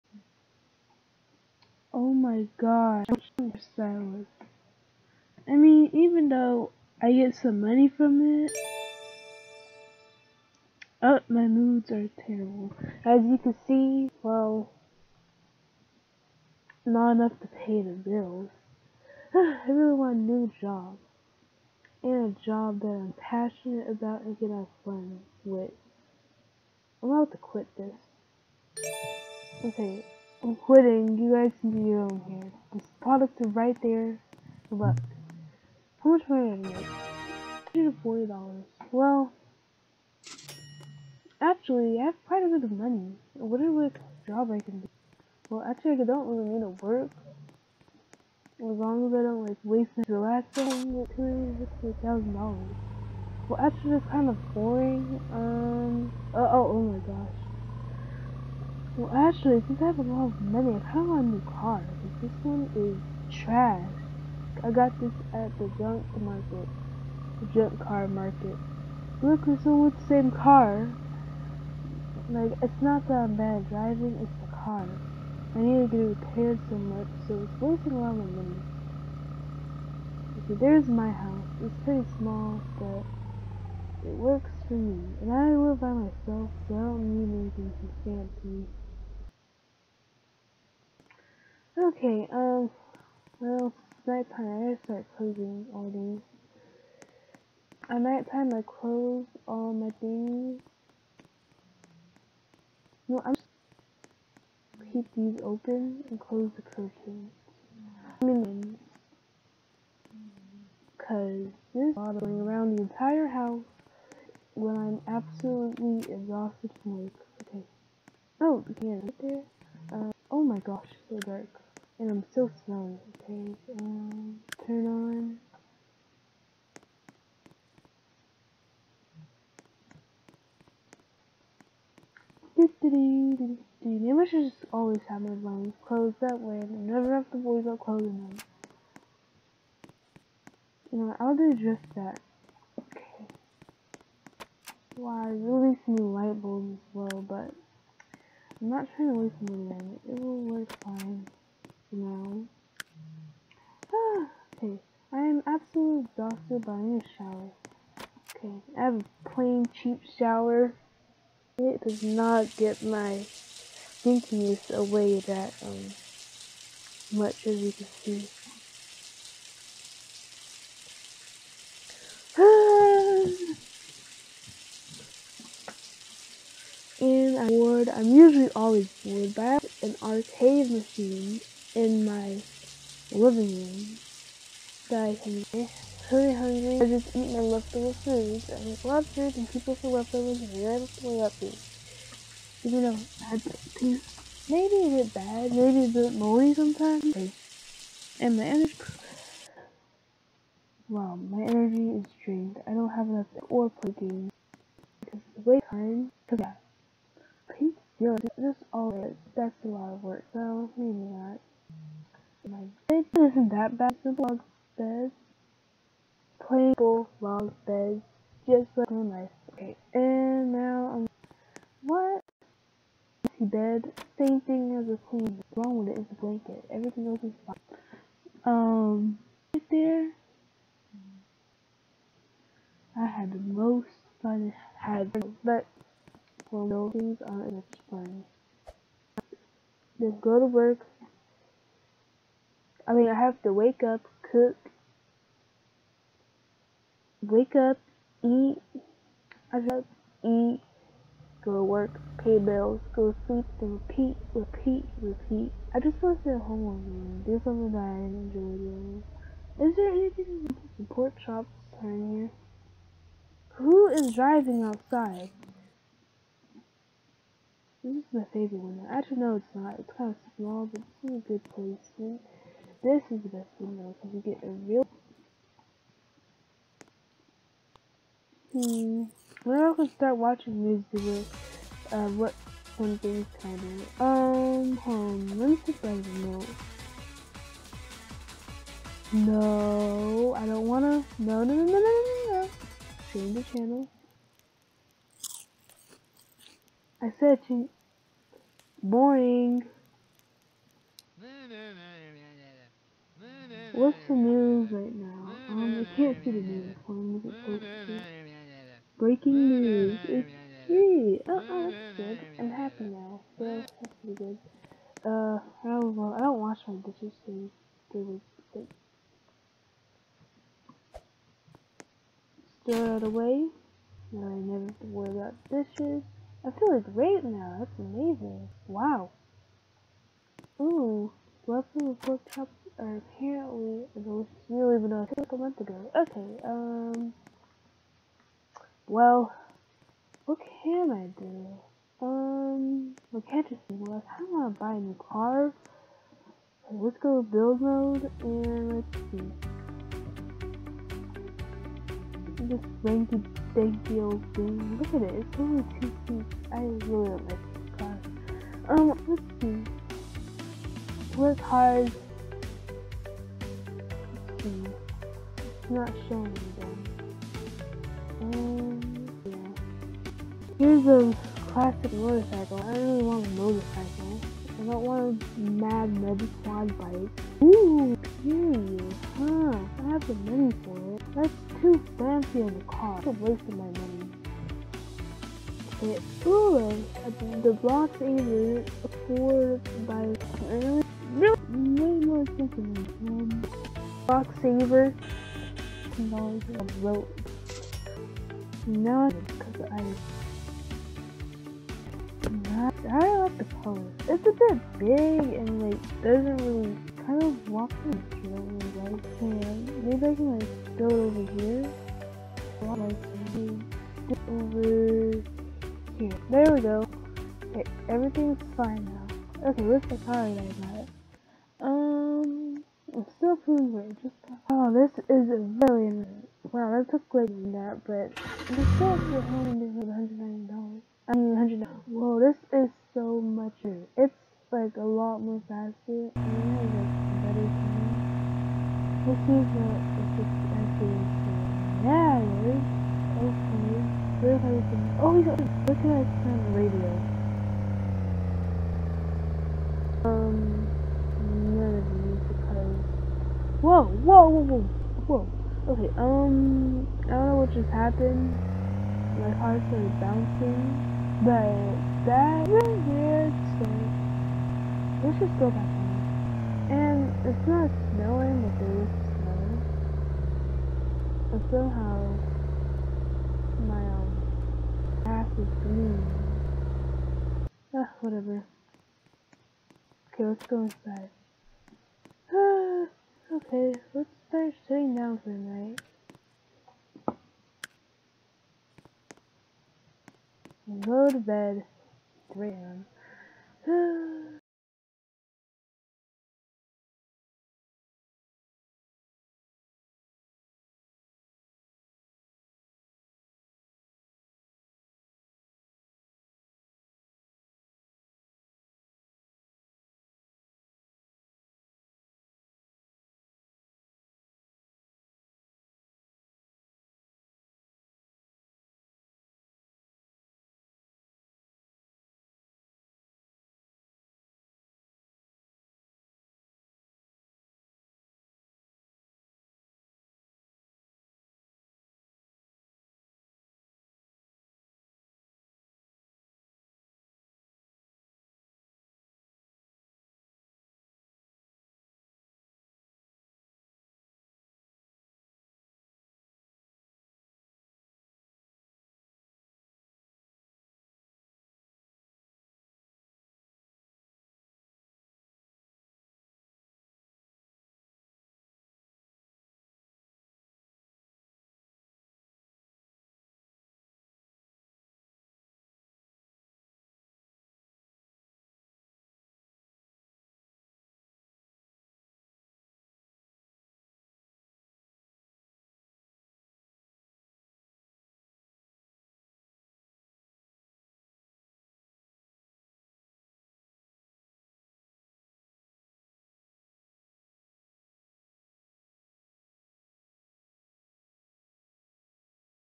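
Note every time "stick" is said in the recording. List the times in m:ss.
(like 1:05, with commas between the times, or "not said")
not said.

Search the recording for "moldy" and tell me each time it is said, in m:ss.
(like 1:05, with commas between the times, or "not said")
3:16.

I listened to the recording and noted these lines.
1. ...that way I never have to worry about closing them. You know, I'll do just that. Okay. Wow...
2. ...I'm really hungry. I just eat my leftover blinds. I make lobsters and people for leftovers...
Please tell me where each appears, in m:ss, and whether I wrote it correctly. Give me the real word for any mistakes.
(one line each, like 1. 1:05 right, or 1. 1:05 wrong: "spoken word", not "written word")
1. 2:16 right
2. 3:05 wrong: "foods", not "blinds".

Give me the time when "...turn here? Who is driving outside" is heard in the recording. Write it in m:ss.
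4:21.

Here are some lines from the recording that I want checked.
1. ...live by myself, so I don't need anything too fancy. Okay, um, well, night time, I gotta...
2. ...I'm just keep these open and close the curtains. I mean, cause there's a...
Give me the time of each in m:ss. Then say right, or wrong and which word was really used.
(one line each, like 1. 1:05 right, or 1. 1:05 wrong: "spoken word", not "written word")
1. 1:25 right
2. 1:43 right.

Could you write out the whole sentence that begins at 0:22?
And a job that I'm passionate about and can have fun with.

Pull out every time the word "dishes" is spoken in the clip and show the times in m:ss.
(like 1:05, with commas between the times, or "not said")
5:16, 5:25.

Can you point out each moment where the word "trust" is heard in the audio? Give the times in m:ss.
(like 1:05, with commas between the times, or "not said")
not said.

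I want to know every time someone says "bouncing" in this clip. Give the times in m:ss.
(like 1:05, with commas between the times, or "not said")
7:40.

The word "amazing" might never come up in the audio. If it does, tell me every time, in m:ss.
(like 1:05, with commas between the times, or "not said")
5:27.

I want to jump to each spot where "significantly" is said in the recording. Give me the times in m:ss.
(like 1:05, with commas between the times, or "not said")
not said.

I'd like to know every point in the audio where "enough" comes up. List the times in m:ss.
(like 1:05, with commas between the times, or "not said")
0:17, 3:23.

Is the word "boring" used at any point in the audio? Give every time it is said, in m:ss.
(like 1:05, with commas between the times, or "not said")
0:54, 4:58.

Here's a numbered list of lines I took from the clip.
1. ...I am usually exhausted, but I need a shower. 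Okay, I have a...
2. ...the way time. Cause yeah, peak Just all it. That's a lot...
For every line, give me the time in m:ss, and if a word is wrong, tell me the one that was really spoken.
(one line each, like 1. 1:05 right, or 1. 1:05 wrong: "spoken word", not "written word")
1. 2:35 wrong: "absolutely", not "usually"
2. 3:25 right.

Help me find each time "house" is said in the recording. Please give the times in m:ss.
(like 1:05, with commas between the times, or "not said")
1:21, 1:53.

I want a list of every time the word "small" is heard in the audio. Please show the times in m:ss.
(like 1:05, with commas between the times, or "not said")
1:22, 4:30.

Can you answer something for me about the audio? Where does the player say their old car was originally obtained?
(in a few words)
the junk car market.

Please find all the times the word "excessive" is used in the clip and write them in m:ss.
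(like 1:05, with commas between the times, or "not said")
not said.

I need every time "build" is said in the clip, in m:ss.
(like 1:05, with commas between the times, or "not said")
5:47.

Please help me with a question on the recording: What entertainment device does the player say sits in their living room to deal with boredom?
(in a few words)
arcade machine.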